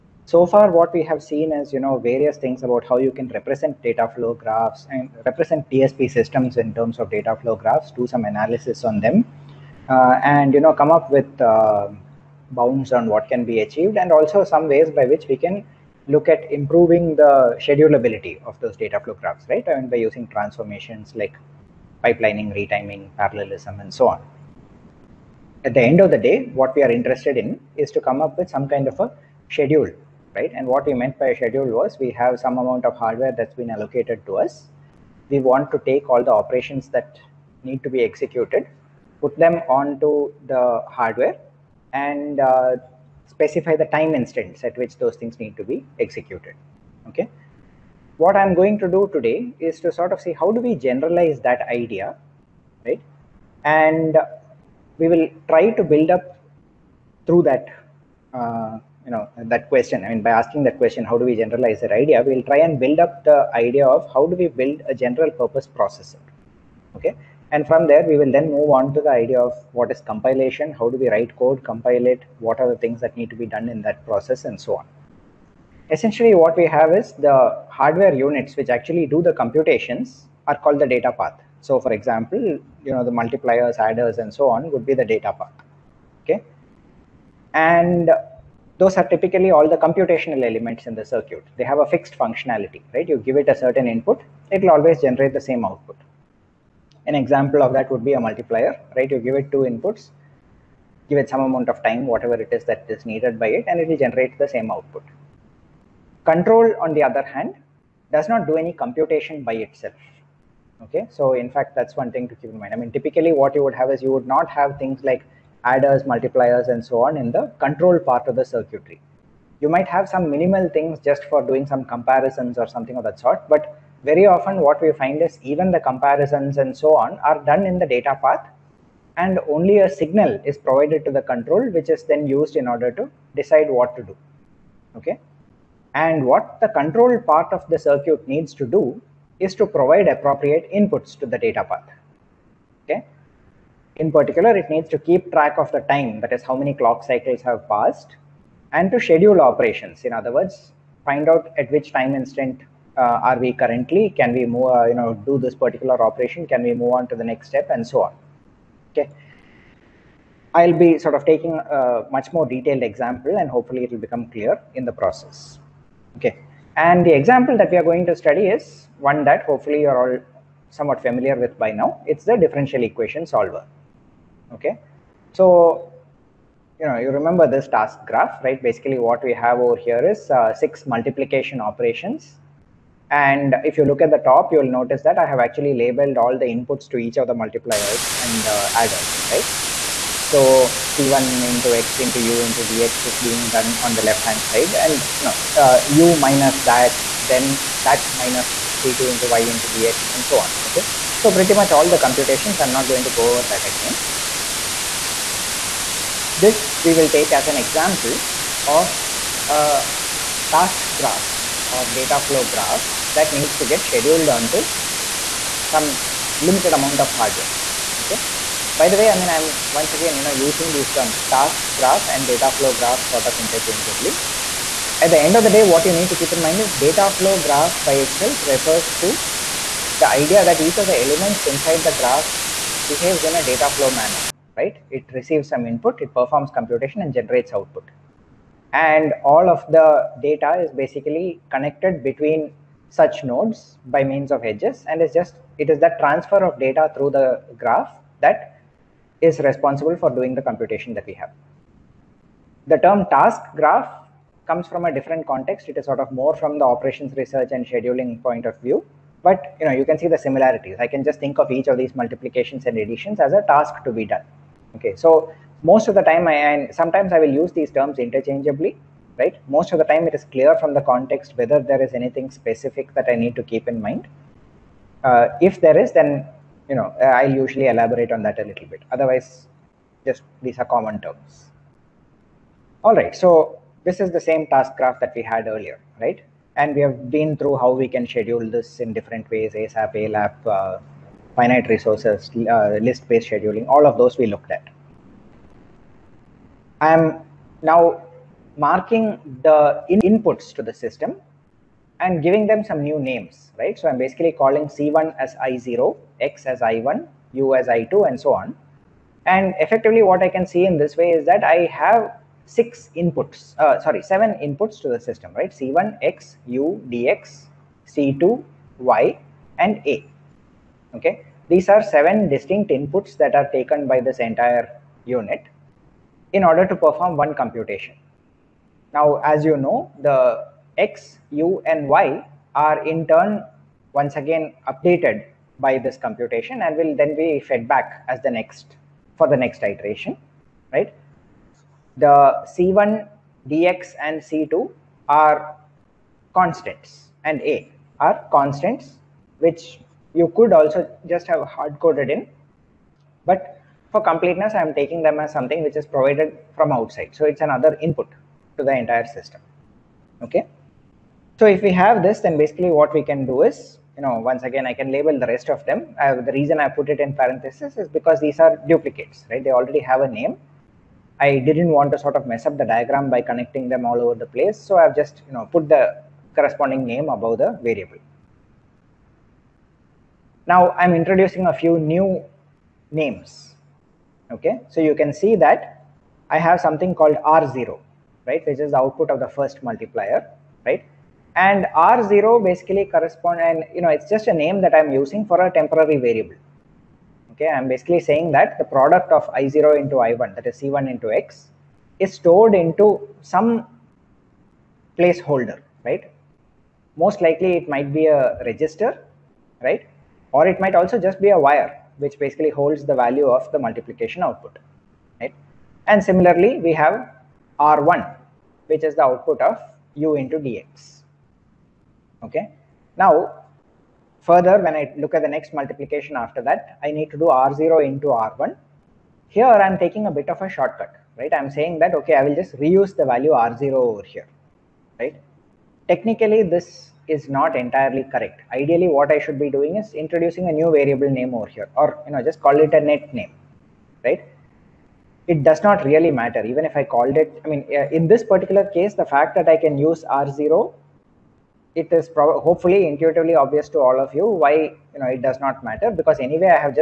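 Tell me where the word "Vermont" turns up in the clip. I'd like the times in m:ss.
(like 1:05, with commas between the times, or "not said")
not said.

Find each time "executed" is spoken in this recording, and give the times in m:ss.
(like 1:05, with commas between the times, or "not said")
0:38, 0:45.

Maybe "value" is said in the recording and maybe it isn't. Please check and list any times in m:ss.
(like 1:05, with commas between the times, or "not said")
6:52, 7:13.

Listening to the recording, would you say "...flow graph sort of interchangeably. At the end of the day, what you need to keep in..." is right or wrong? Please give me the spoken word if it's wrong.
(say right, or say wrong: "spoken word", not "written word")
right.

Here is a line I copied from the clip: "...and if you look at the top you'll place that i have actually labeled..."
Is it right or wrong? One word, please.
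wrong.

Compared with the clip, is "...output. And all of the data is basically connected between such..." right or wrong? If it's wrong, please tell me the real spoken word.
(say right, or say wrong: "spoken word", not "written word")
right.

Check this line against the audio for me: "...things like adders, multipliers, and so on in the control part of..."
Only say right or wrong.
right.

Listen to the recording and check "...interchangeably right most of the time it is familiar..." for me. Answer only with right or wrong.
wrong.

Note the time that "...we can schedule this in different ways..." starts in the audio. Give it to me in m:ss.
4:47.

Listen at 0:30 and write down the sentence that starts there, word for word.
And what we meant by schedule was we have some amount of hardware that's been allocated to us.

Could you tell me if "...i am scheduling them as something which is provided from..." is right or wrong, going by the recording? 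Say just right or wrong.
wrong.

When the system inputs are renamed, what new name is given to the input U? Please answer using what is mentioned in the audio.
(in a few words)
I2.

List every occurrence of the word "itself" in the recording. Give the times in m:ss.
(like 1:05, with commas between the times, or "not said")
1:49, 3:48.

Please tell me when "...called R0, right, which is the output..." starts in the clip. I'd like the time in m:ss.
6:26.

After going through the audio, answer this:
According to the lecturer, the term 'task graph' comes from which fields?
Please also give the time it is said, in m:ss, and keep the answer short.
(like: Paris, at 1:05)
Operations research and scheduling, at 4:16.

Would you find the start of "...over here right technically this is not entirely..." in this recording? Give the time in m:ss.
7:13.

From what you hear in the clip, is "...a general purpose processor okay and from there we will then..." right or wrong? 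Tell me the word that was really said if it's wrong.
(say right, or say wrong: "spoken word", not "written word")
right.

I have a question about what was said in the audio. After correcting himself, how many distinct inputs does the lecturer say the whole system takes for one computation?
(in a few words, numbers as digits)
7.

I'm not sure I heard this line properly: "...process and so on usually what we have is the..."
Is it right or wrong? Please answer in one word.
wrong.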